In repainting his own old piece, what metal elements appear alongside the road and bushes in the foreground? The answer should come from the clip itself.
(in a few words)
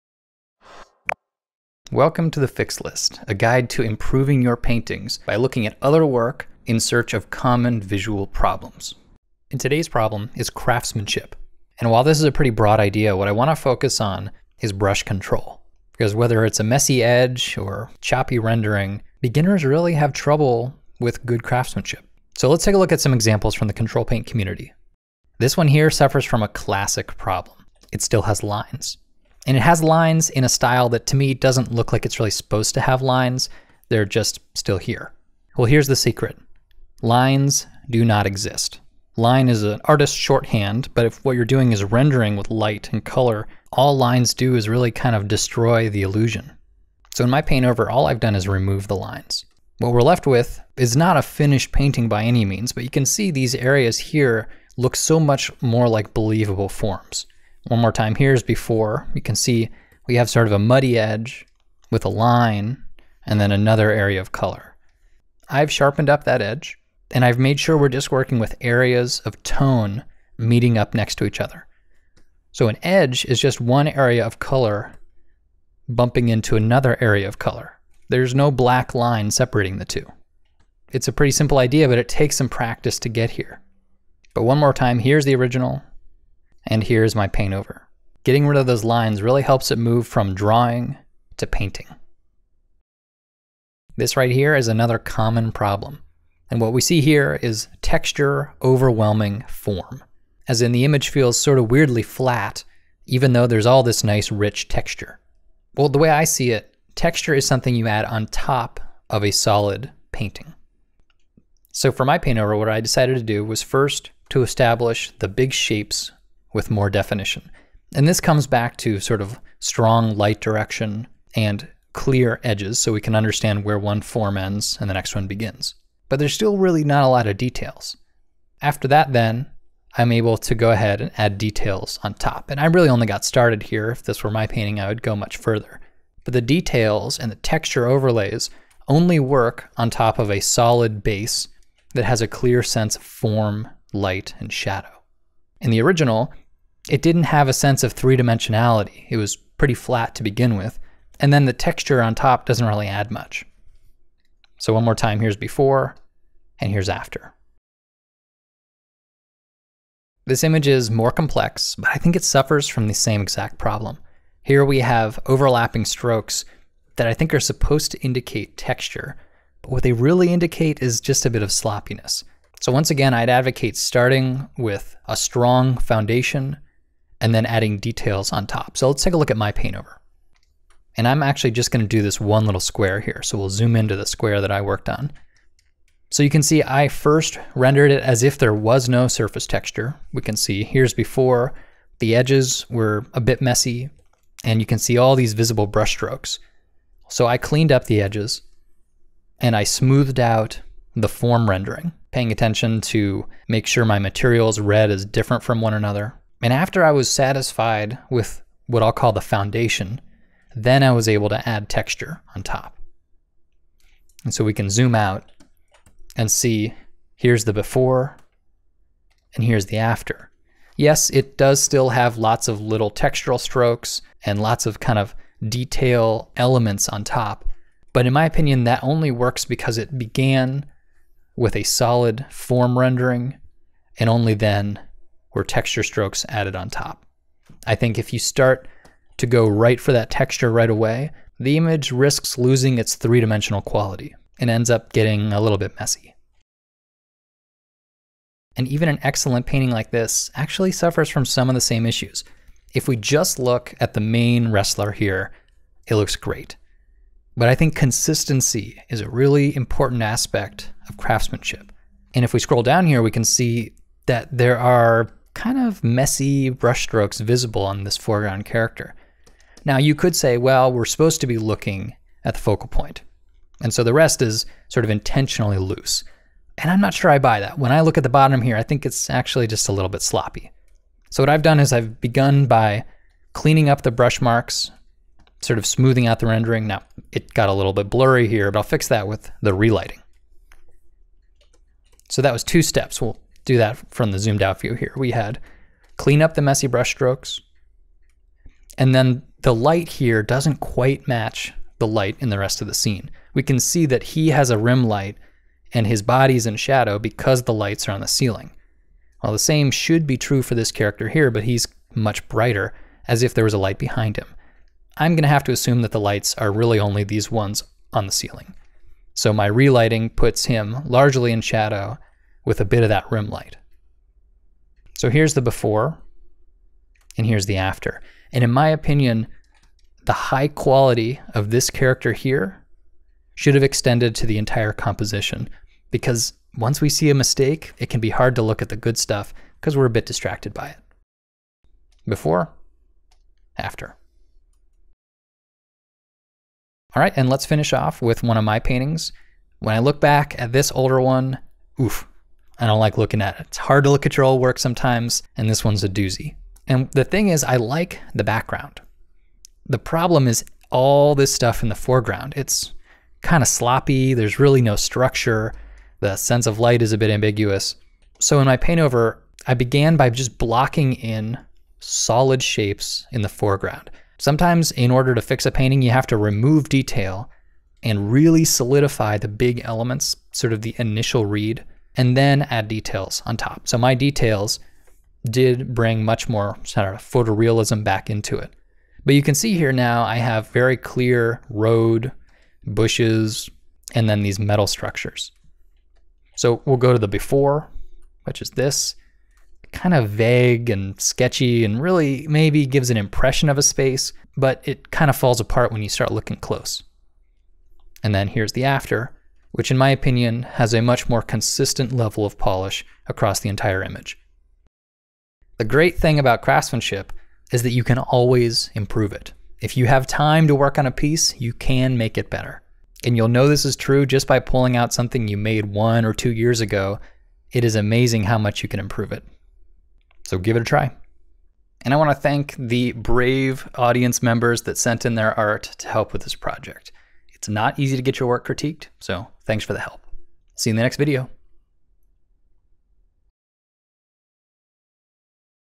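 metal structures.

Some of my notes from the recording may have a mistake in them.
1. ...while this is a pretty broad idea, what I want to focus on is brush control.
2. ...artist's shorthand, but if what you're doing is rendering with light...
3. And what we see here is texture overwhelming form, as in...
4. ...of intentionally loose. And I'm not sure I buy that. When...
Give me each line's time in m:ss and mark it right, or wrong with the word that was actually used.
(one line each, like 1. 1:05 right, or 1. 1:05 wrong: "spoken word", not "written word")
1. 0:11 right
2. 0:39 right
3. 1:36 right
4. 4:34 right.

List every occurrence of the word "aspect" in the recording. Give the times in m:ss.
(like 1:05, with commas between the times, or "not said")
4:20.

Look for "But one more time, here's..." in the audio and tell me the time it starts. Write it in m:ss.
1:24.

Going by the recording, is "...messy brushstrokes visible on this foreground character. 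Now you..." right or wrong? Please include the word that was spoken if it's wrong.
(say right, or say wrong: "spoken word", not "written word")
right.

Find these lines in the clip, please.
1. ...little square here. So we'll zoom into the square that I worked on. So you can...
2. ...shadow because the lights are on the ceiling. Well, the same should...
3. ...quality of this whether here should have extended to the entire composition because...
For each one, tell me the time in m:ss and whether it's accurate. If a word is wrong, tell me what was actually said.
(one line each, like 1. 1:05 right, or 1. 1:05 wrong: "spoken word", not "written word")
1. 3:02 right
2. 5:06 right
3. 5:30 wrong: "character", not "whether".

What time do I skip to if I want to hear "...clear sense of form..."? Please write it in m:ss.
2:22.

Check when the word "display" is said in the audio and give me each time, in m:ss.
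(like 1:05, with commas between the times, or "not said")
not said.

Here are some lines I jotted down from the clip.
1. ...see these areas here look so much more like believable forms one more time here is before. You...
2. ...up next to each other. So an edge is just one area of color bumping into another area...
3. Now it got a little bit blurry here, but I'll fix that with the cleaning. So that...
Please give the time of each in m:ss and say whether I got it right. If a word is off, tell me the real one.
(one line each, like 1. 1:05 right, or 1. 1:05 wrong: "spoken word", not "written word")
1. 0:53 right
2. 1:10 right
3. 4:46 wrong: "relighting", not "cleaning".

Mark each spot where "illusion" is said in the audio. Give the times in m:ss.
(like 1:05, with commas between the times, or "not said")
0:46.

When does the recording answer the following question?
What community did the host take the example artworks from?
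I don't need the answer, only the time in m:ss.
0:23.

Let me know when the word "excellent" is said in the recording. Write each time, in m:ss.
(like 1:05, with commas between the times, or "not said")
4:09.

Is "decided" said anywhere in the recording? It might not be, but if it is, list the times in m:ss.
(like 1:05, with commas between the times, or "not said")
1:52.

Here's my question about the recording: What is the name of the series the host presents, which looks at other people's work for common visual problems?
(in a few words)
the Fix List.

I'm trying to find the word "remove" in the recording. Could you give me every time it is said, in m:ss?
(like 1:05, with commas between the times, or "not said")
0:48, 6:16.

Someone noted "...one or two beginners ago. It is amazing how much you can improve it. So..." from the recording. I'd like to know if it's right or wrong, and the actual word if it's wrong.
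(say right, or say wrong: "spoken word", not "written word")
wrong: "years", not "beginners".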